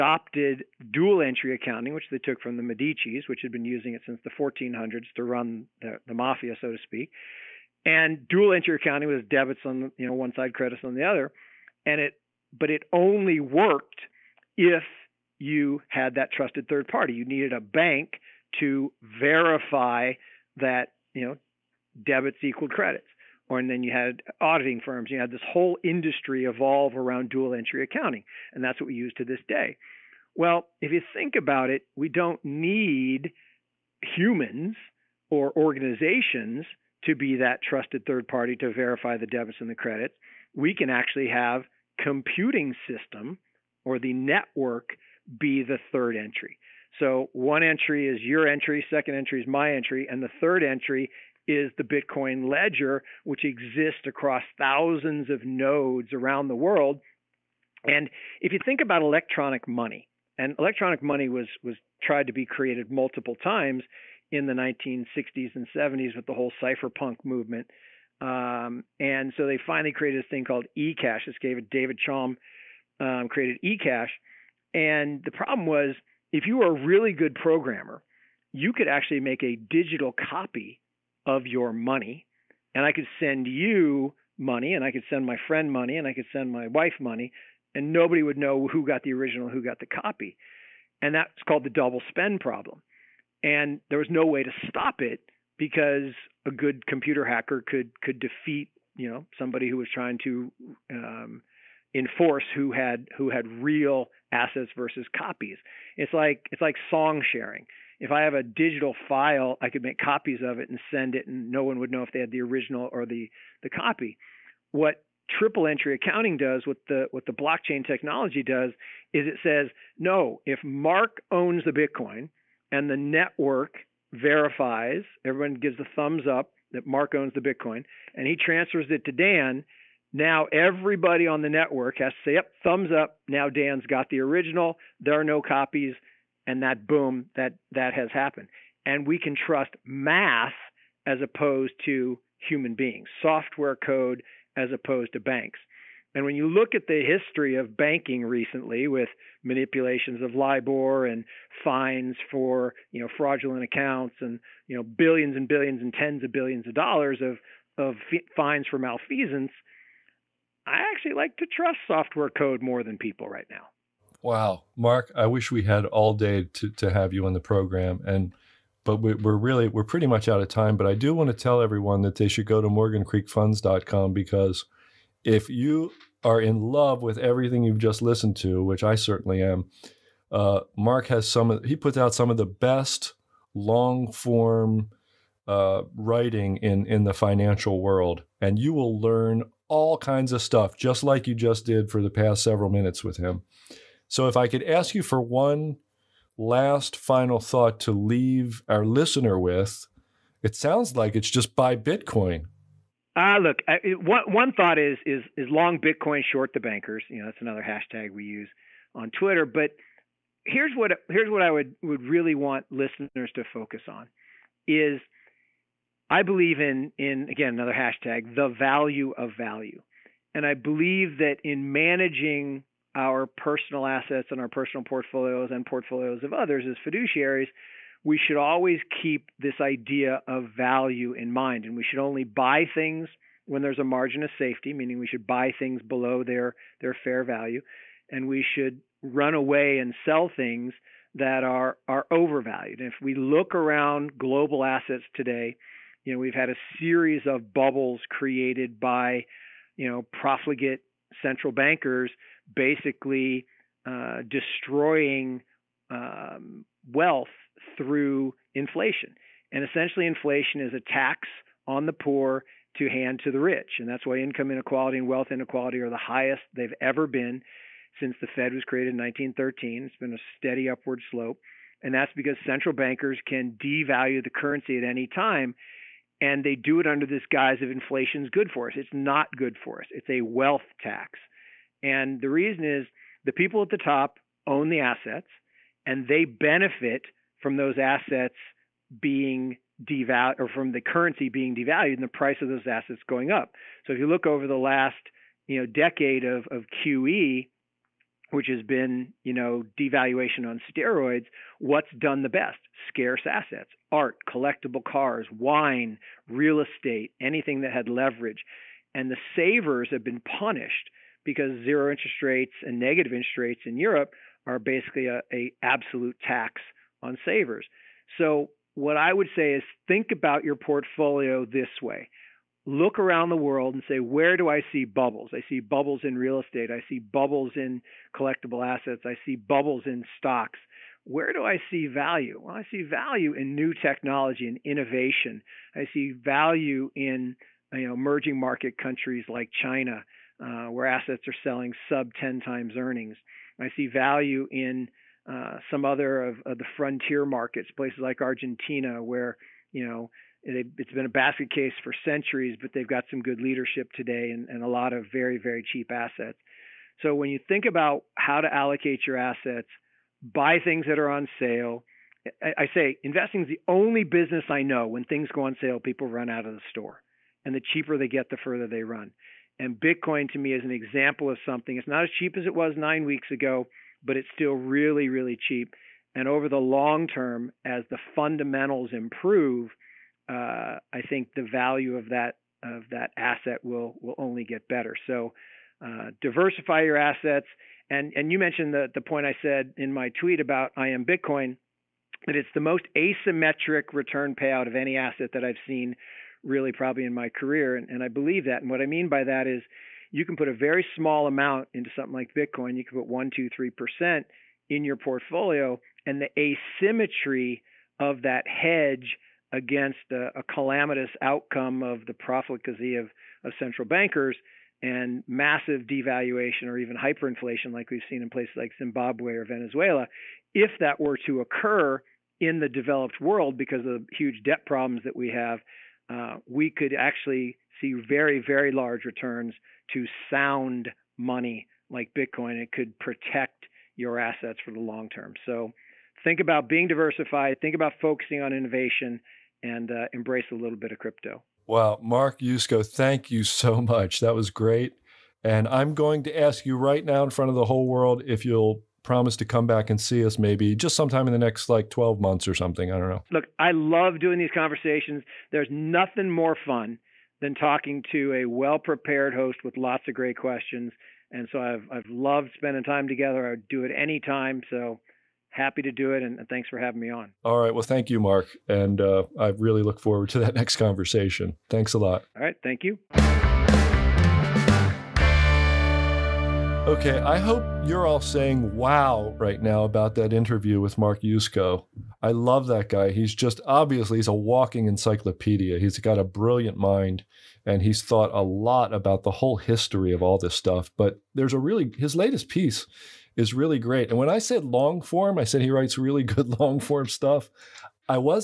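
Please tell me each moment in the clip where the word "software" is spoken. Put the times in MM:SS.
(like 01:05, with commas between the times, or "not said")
02:23, 02:41.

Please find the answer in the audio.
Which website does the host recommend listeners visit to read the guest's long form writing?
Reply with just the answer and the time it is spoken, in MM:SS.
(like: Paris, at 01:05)
MorganCreekFunds.com, at 02:52.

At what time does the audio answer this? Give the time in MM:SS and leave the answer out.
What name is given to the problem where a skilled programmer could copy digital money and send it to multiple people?
01:31.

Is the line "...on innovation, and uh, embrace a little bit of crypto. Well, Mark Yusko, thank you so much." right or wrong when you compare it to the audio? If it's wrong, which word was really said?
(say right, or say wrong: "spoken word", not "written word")
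right.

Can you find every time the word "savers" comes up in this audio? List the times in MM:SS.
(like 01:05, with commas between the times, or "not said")
05:09, 05:17.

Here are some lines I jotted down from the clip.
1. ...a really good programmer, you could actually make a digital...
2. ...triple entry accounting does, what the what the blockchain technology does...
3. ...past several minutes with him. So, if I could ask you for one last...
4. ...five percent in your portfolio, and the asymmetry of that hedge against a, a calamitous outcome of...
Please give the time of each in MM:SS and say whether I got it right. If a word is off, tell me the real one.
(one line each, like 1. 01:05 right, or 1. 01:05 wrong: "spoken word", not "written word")
1. 01:16 right
2. 01:55 right
3. 03:12 right
4. 06:43 wrong: "three", not "five".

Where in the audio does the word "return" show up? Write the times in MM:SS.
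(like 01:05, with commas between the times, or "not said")
06:33, 07:09.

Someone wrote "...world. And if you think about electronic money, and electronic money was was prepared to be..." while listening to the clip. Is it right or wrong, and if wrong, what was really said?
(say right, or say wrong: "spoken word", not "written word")
wrong: "tried", not "prepared".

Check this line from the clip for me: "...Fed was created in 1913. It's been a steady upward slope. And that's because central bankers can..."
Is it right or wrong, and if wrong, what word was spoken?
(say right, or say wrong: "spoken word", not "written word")
right.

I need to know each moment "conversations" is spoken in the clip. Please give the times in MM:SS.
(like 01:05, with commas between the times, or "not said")
07:34, 07:50.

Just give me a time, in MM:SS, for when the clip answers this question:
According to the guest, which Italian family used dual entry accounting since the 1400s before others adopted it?
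00:02.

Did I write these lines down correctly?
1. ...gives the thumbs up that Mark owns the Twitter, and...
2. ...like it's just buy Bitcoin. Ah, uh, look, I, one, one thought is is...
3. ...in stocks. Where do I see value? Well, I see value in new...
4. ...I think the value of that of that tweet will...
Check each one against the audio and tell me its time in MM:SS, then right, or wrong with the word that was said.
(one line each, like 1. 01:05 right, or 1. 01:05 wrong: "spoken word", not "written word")
1. 02:05 wrong: "Bitcoin", not "Twitter"
2. 03:20 right
3. 05:29 right
4. 06:20 wrong: "asset", not "tweet".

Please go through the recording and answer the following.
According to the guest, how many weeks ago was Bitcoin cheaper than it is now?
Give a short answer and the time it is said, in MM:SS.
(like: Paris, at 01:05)
9, at 06:12.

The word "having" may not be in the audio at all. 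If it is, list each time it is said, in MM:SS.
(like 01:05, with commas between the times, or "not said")
07:46.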